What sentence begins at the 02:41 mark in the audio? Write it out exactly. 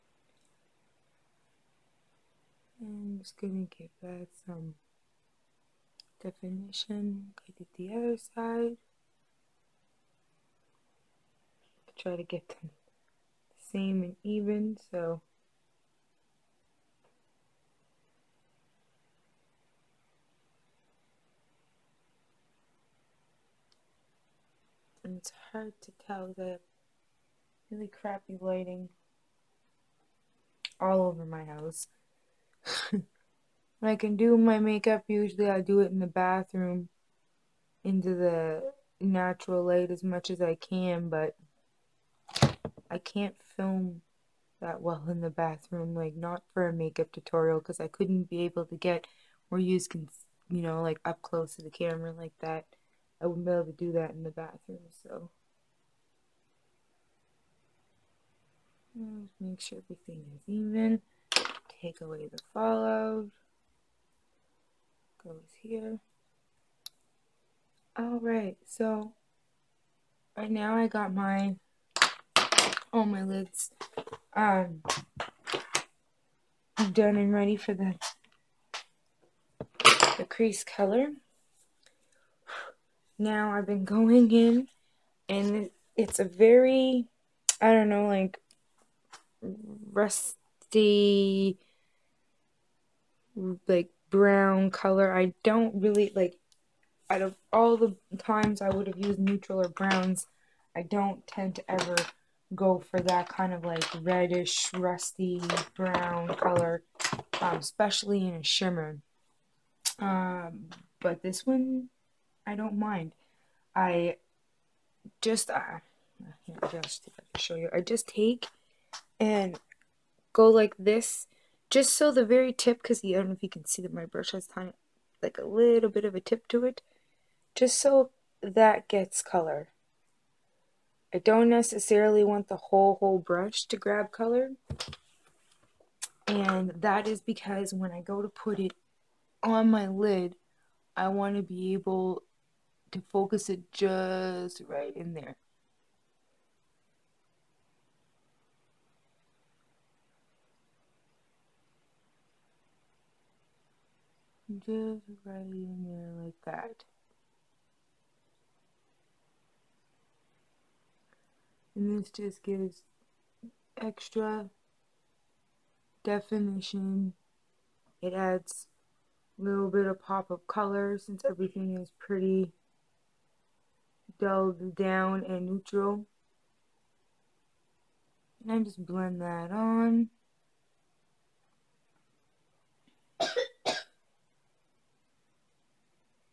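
And this just gives extra definition.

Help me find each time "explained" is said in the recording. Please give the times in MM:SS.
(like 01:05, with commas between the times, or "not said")
not said.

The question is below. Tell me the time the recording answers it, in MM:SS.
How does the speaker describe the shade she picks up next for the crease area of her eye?
01:29.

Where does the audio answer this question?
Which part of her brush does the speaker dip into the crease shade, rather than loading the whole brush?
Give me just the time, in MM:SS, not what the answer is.
02:02.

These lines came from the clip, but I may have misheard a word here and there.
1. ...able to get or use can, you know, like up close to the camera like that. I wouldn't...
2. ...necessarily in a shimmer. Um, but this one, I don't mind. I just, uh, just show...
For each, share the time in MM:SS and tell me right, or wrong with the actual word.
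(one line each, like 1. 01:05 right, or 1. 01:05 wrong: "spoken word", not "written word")
1. 00:48 right
2. 01:47 wrong: "especially", not "necessarily".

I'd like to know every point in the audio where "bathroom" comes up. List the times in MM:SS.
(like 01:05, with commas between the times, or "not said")
00:36, 00:45, 00:54.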